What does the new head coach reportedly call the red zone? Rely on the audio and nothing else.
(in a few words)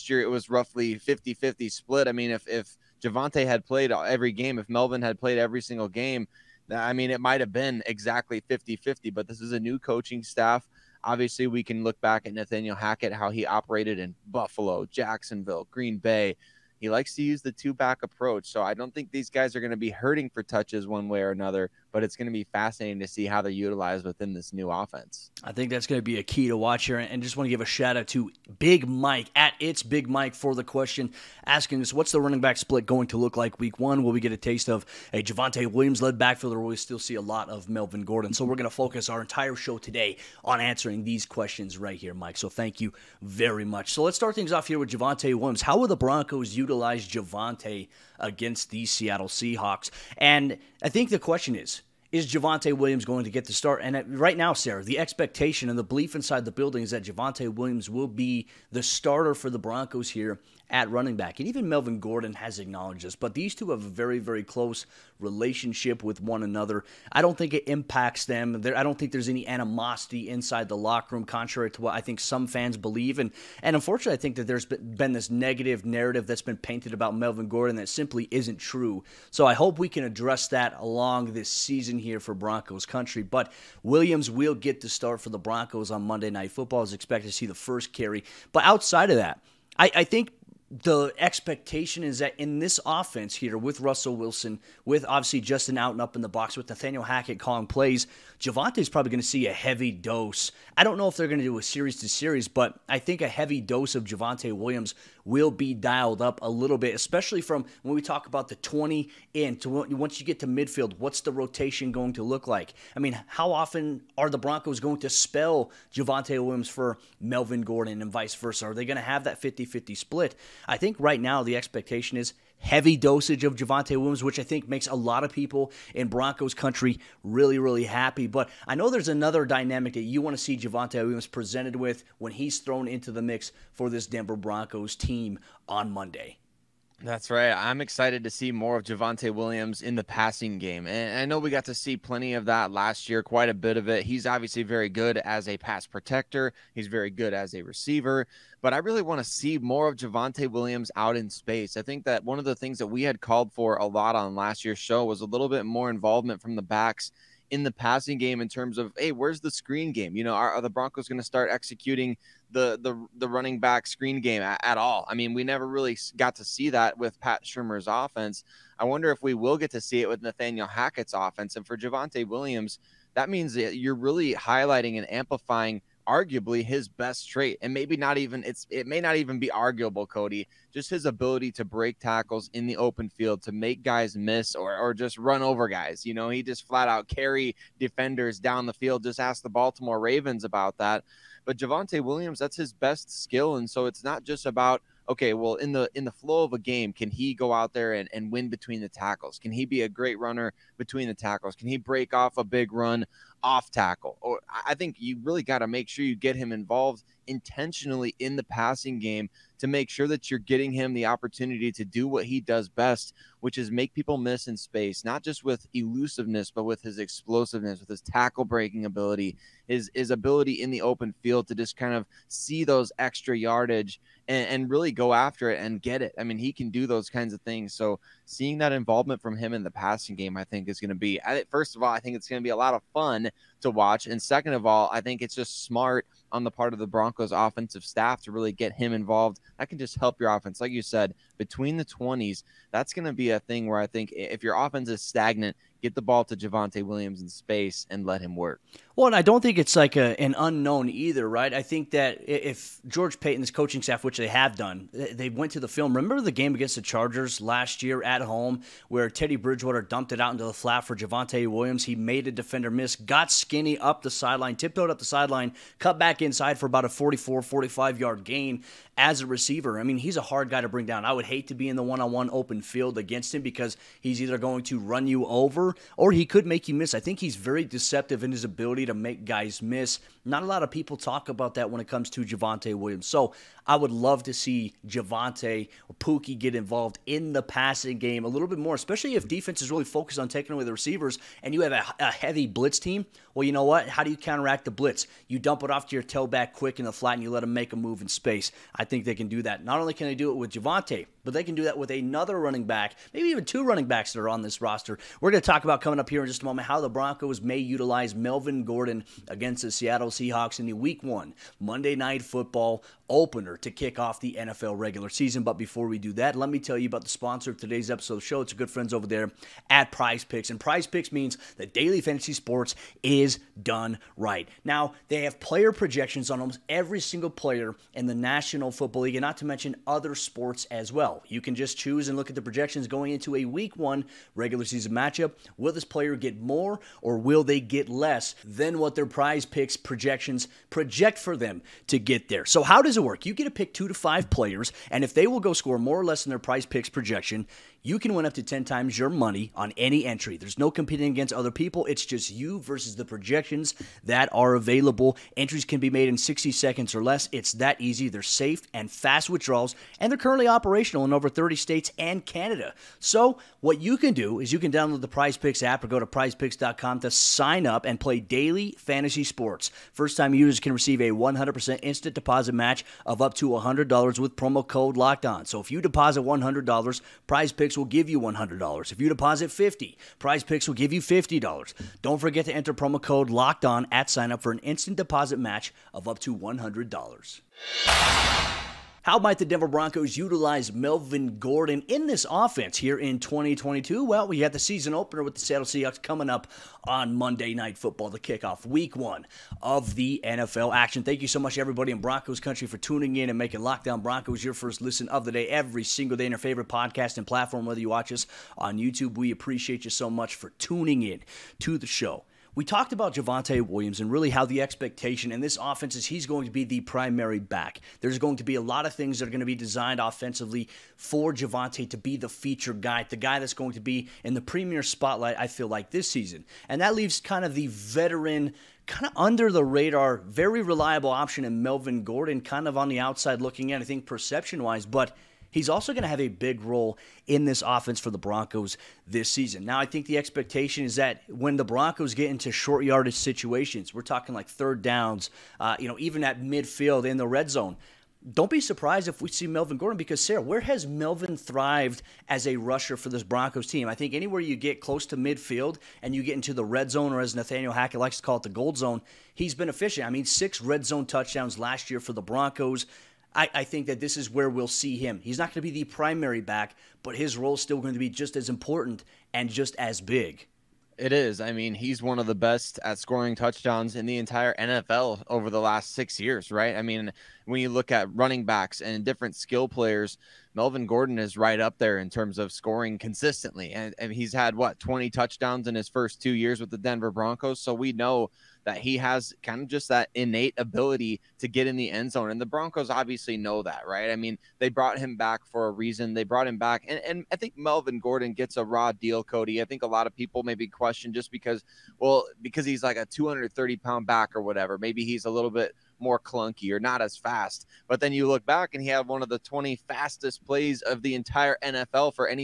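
the gold zone.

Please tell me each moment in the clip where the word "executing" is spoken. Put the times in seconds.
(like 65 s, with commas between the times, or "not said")
161 s.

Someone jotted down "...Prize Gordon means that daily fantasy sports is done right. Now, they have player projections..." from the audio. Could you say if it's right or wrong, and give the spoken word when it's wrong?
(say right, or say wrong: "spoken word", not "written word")
wrong: "Picks", not "Gordon".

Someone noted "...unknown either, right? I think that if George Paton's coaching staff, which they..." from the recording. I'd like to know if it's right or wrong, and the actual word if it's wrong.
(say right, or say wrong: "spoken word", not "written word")
right.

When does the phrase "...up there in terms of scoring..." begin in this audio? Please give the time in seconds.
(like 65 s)
481 s.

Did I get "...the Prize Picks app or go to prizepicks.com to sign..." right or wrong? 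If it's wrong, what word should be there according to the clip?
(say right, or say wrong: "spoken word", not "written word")
right.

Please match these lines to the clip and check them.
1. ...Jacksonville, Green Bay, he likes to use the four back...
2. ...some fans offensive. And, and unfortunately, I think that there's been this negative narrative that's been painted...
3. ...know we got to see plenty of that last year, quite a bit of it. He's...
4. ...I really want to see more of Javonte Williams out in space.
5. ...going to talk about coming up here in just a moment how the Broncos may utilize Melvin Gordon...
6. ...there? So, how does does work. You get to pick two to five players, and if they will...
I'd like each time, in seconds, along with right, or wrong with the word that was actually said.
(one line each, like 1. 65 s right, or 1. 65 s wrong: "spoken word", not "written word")
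1. 14 s wrong: "two", not "four"
2. 72 s wrong: "believe", not "offensive"
3. 141 s right
4. 148 s right
5. 305 s right
6. 342 s right.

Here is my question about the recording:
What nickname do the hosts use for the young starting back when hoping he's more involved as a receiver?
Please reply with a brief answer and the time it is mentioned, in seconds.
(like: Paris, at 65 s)
Pookie, at 285 s.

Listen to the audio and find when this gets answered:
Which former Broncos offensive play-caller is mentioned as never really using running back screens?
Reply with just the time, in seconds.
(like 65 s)
167 s.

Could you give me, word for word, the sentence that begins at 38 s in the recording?
So we're going to focus our entire show today on answering these questions right here, Mike.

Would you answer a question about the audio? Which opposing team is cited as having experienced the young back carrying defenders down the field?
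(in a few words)
Baltimore Ravens.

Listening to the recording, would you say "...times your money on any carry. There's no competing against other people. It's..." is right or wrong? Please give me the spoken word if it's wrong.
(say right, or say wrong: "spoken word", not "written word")
wrong: "entry", not "carry".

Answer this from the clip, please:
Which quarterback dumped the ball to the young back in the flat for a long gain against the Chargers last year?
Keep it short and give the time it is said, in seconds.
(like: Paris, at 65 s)
Teddy Bridgewater, at 259 s.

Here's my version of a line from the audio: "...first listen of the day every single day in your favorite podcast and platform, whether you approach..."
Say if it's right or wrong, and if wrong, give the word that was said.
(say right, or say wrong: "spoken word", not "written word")
wrong: "watch", not "approach".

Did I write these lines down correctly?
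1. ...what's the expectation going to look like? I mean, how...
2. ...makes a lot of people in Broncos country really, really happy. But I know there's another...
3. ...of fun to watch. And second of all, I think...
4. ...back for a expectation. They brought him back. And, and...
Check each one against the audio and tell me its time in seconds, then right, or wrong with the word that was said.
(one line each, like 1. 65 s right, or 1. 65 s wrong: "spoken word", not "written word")
1. 110 s wrong: "rotation", not "expectation"
2. 124 s right
3. 232 s right
4. 495 s wrong: "reason", not "expectation".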